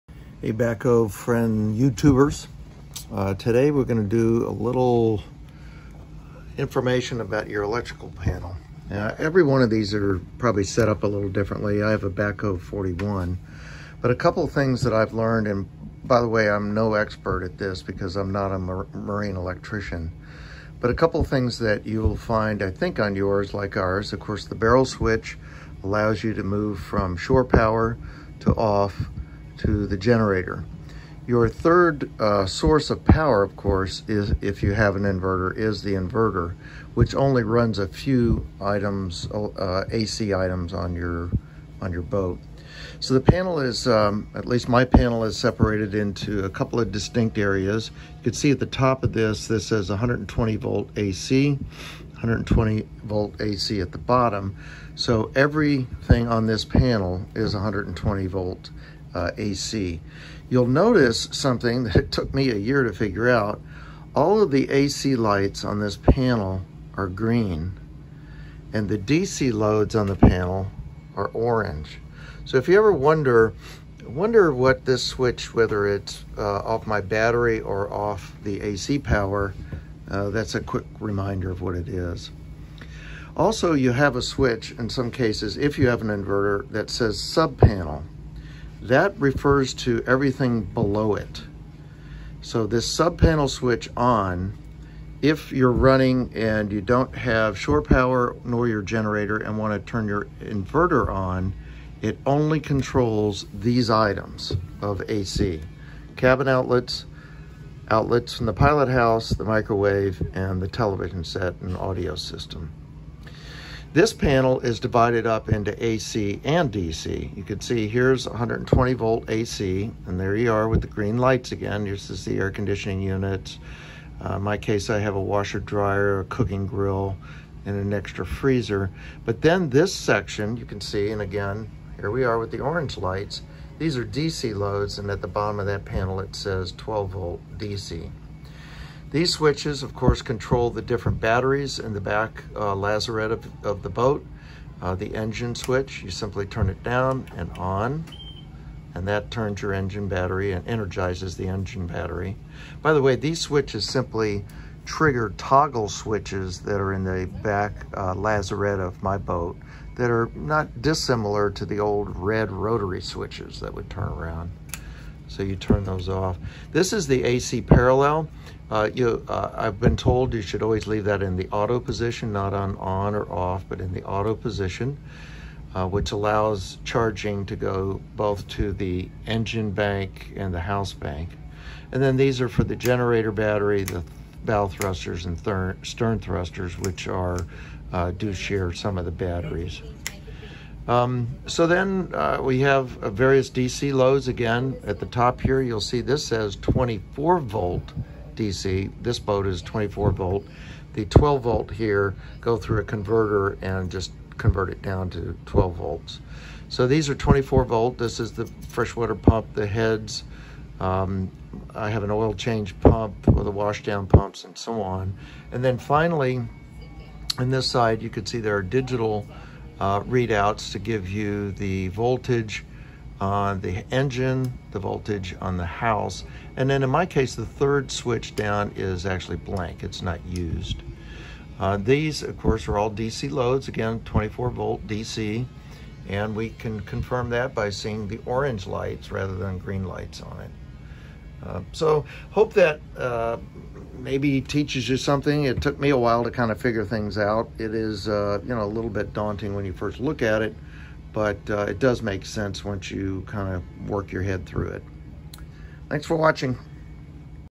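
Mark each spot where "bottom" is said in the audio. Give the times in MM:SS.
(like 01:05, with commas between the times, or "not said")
00:53, 02:15.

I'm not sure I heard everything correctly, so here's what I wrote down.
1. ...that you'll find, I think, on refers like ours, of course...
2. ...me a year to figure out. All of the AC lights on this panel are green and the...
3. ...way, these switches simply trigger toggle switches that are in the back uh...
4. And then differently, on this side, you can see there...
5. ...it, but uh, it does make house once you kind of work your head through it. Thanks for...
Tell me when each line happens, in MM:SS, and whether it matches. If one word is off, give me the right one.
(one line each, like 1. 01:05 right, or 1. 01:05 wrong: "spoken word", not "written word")
1. 00:21 wrong: "yours", not "refers"
2. 01:02 right
3. 02:33 right
4. 03:35 wrong: "finally", not "differently"
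5. 04:10 wrong: "sense", not "house".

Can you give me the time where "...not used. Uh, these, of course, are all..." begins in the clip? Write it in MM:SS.
03:50.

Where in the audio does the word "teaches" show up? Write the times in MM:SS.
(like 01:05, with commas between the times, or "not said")
04:04.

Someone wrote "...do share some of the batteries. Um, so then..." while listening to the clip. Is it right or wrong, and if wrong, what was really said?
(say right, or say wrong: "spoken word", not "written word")
right.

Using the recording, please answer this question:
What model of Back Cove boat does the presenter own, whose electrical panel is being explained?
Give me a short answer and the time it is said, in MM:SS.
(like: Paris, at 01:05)
Back Cove 41, at 00:12.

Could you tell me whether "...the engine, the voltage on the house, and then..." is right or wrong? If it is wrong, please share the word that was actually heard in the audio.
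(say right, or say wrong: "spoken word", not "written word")
right.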